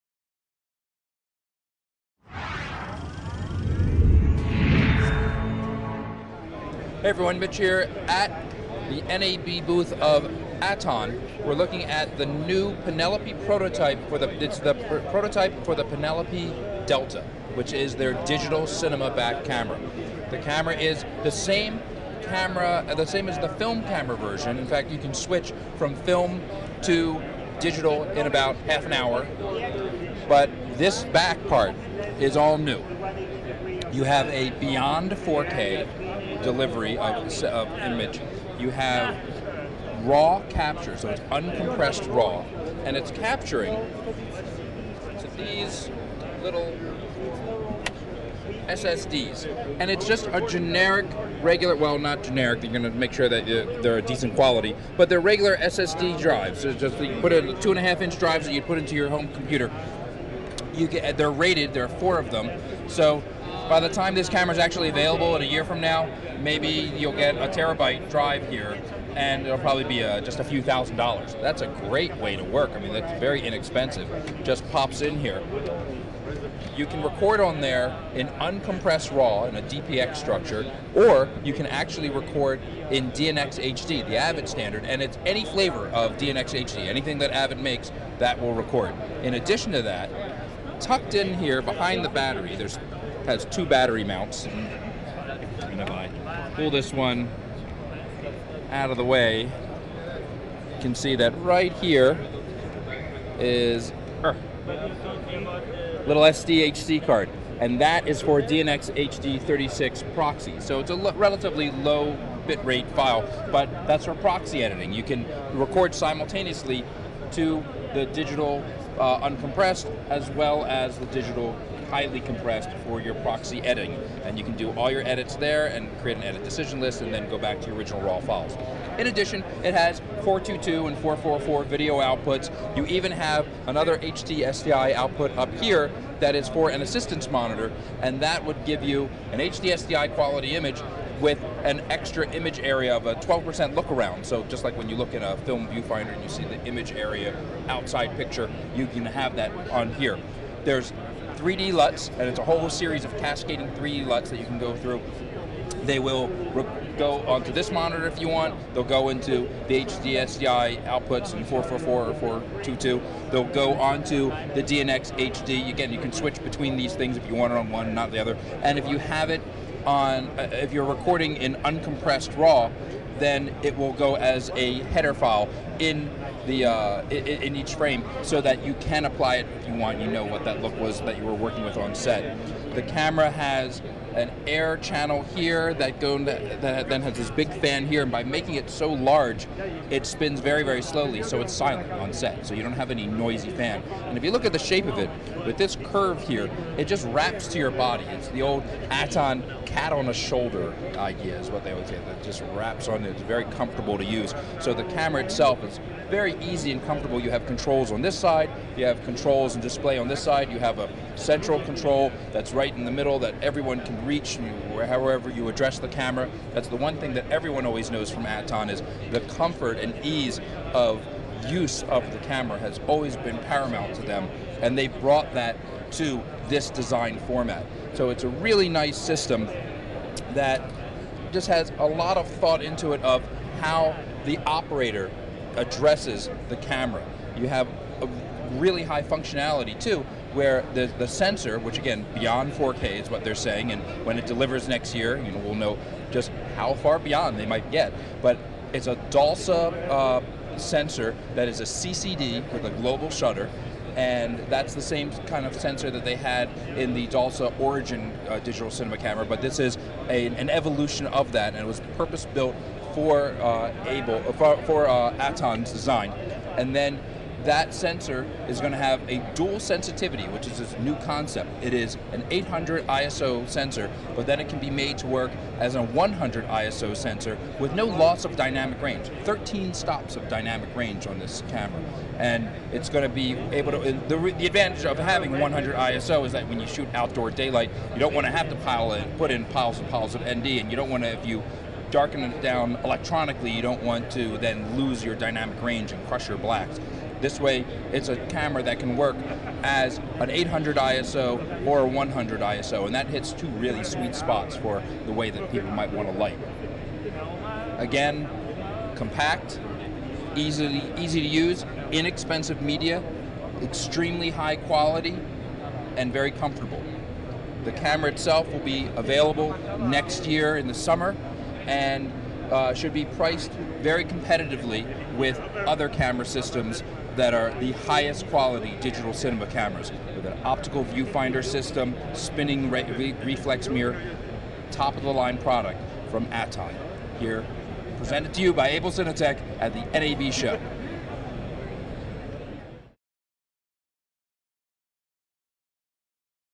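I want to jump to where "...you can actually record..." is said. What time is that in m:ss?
1:21.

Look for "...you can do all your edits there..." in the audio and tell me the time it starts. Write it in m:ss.
2:04.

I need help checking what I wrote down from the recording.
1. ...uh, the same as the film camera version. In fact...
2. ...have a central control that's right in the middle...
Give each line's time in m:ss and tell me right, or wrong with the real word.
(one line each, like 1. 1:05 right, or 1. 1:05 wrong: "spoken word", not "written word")
1. 0:22 right
2. 3:30 right.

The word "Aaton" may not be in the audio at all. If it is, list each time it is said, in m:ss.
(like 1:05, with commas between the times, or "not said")
0:10, 3:18, 3:38, 4:25, 5:36.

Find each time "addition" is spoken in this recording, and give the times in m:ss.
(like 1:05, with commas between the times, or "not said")
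1:29, 2:09.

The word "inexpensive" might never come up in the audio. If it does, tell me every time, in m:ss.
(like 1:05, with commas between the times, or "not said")
1:13, 5:11.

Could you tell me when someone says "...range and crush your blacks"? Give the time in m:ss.
4:55.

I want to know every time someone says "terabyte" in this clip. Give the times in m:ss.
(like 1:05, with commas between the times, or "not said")
1:07.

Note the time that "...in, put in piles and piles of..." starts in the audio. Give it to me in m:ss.
4:48.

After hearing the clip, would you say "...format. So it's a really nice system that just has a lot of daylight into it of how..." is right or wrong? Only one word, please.
wrong.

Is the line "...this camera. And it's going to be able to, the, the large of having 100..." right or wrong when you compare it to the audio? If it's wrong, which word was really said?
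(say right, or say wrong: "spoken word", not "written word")
wrong: "advantage", not "large".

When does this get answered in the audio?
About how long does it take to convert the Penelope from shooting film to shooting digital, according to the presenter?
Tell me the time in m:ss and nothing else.
0:28.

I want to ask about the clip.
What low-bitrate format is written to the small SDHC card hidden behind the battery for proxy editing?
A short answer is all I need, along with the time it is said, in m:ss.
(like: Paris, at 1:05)
DNxHD36, at 1:48.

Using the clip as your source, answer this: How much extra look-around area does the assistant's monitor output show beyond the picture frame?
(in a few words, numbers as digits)
12%.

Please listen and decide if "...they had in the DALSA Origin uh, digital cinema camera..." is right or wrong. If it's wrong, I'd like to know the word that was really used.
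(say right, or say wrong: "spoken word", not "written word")
right.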